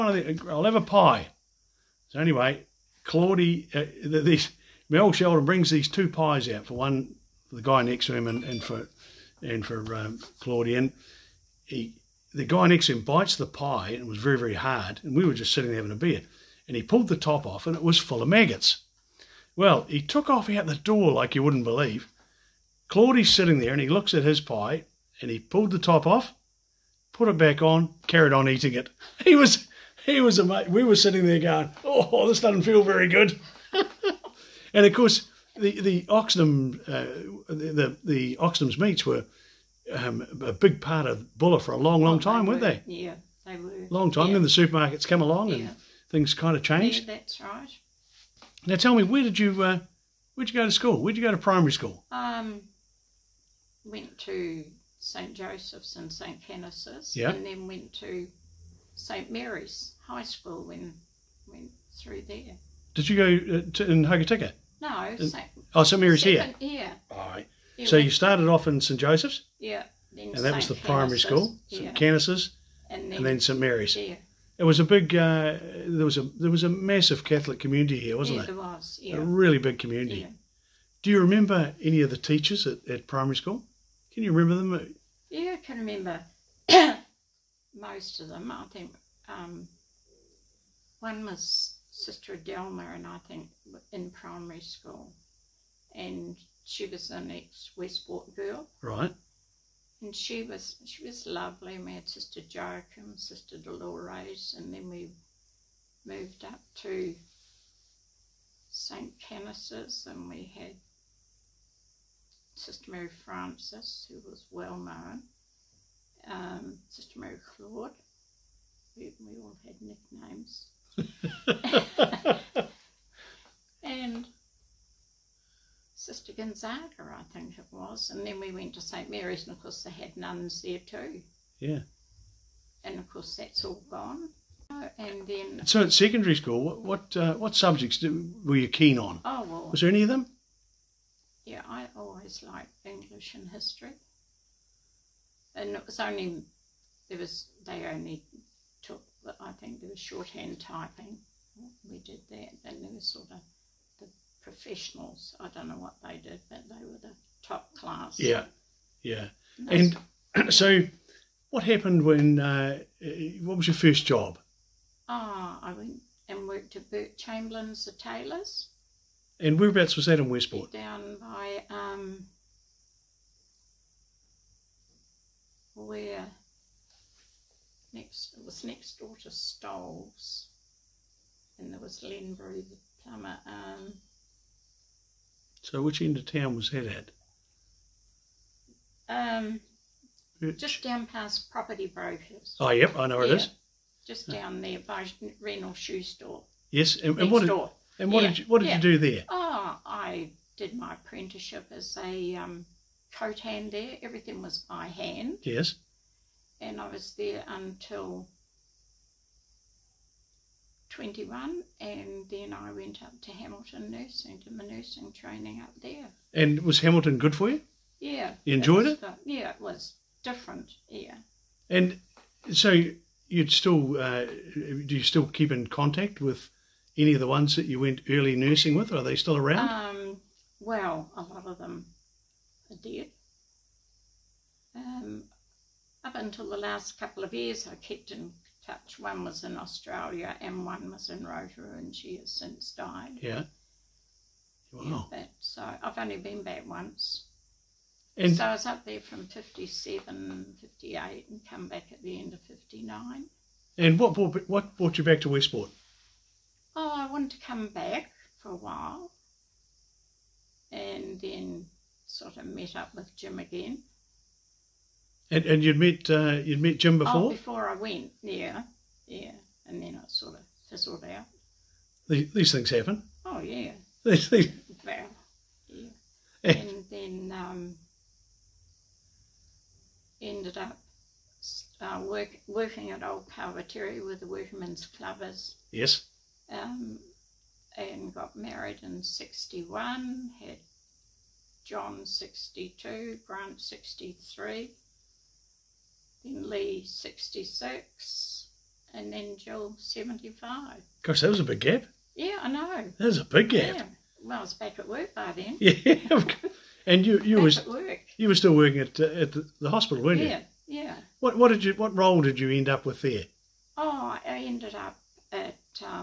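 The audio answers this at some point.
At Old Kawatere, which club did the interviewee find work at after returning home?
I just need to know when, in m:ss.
4:44.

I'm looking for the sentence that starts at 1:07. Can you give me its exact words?
Yeah, so you started off in St Joseph's.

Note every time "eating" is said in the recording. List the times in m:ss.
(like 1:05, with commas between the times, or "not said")
0:28.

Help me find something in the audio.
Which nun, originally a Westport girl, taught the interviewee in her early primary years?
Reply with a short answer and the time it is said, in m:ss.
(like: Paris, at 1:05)
Sister Adelma, at 1:31.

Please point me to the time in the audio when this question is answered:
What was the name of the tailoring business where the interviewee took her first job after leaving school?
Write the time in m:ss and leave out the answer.
2:46.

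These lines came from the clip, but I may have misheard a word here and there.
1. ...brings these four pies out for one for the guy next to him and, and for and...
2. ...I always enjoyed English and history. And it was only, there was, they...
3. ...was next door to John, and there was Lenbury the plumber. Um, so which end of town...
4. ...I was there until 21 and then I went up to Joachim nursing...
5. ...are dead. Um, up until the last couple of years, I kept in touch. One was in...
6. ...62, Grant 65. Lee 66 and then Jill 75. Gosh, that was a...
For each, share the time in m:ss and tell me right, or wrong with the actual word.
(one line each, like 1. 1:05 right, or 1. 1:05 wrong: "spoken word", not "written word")
1. 0:05 wrong: "two", not "four"
2. 2:21 wrong: "liked", not "enjoyed"
3. 2:58 wrong: "Stoles", not "John"
4. 3:26 wrong: "Hamilton", not "Joachim"
5. 3:52 right
6. 4:52 wrong: "63", not "65".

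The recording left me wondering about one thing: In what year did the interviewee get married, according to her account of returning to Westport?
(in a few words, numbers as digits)
1961.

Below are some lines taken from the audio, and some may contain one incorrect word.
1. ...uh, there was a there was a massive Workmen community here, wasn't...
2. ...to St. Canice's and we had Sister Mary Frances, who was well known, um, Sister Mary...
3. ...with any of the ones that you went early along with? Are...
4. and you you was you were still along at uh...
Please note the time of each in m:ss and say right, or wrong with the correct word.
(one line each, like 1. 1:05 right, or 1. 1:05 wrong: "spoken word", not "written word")
1. 1:15 wrong: "Catholic", not "Workmen"
2. 1:46 right
3. 3:46 wrong: "nursing", not "along"
4. 5:06 wrong: "working", not "along".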